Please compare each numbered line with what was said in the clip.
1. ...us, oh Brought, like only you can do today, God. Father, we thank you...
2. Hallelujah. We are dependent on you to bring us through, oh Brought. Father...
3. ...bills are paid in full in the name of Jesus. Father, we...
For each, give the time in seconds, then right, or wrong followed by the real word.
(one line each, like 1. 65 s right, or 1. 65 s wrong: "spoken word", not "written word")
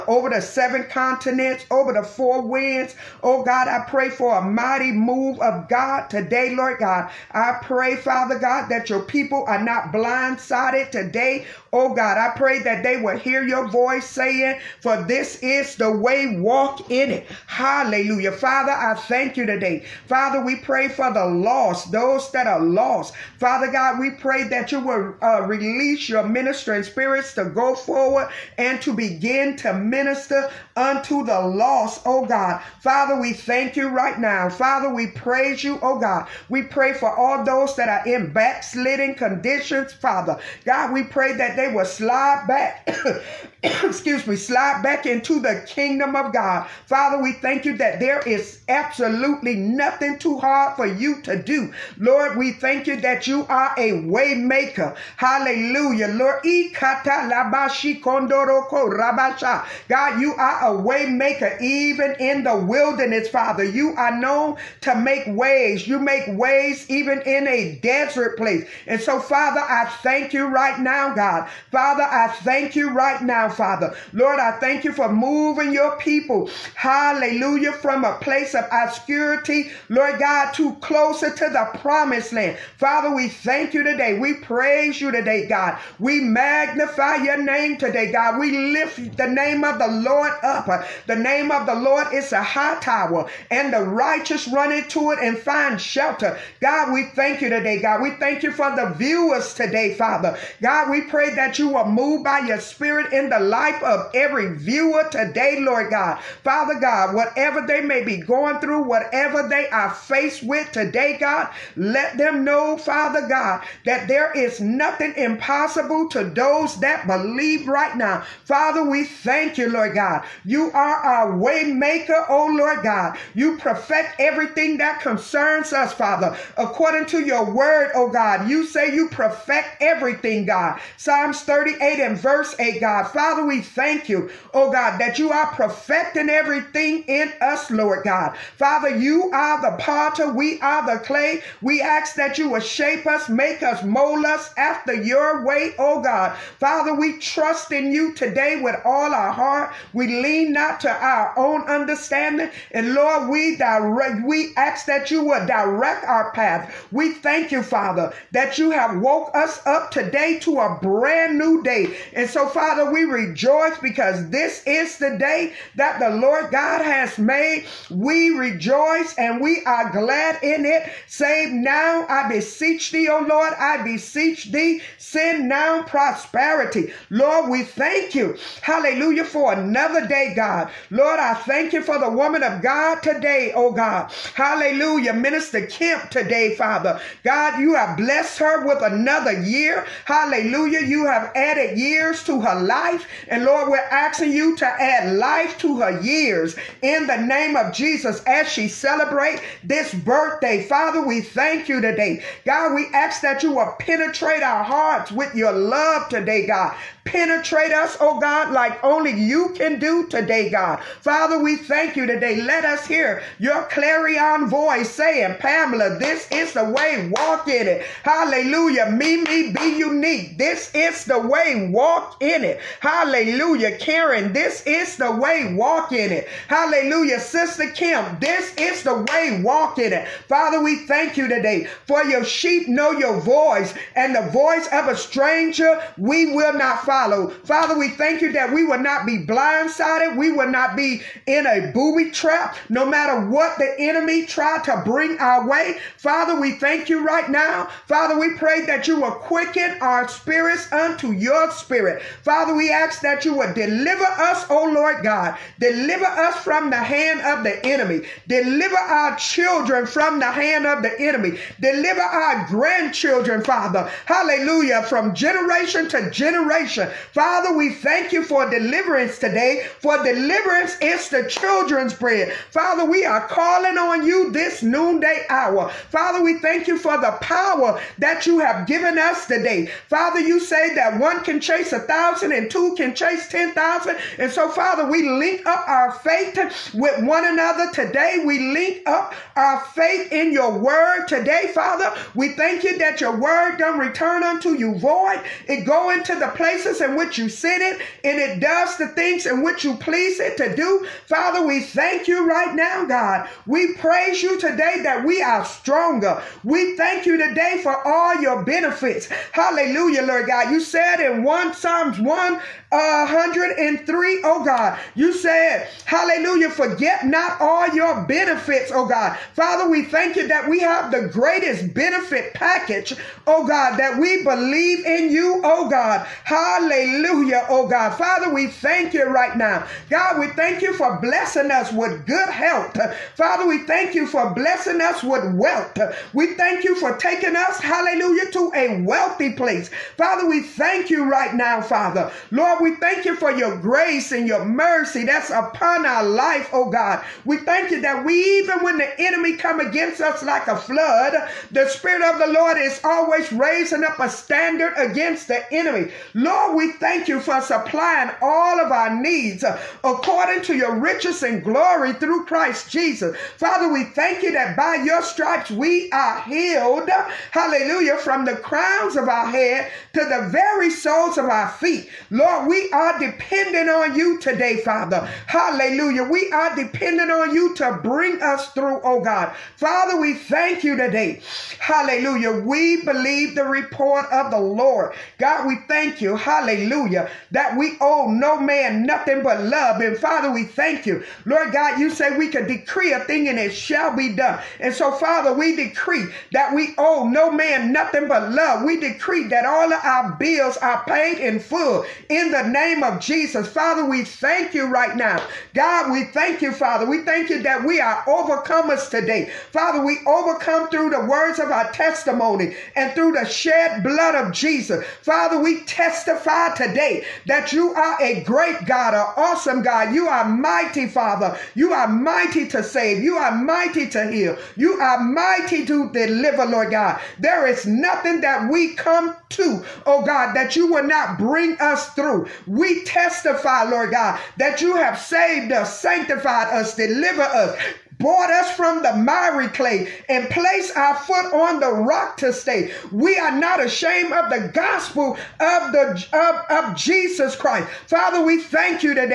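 1. 207 s wrong: "God", not "Brought"
2. 375 s wrong: "God", not "Brought"
3. 400 s right.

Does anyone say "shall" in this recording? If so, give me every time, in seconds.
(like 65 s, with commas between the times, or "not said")
393 s.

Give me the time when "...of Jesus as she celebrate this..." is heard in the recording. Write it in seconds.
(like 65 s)
197 s.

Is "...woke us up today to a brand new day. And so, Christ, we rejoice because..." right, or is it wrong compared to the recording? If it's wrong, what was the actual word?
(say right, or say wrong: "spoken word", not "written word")
wrong: "Father", not "Christ".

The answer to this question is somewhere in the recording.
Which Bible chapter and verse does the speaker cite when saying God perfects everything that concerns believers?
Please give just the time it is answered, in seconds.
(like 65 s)
130 s.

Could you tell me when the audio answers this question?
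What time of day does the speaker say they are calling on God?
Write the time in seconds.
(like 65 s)
274 s.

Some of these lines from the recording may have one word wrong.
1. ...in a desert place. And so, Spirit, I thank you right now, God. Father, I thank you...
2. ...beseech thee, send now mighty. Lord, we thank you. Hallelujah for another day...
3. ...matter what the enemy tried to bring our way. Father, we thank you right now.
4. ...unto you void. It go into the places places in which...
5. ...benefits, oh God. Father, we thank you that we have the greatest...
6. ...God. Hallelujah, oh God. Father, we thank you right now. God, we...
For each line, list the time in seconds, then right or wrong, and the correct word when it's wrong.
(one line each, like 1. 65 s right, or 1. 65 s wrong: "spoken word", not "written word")
1. 67 s wrong: "Father", not "Spirit"
2. 173 s wrong: "prosperity", not "mighty"
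3. 242 s right
4. 294 s right
5. 318 s right
6. 325 s right.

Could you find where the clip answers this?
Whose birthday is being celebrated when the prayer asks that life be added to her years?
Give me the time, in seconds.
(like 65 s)
185 s.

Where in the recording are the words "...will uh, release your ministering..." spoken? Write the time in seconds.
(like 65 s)
24 s.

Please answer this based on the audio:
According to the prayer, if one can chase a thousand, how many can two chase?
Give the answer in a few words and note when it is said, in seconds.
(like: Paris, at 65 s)
10000, at 283 s.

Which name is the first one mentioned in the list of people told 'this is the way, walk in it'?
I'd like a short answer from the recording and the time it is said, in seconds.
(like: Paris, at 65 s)
Pamela, at 215 s.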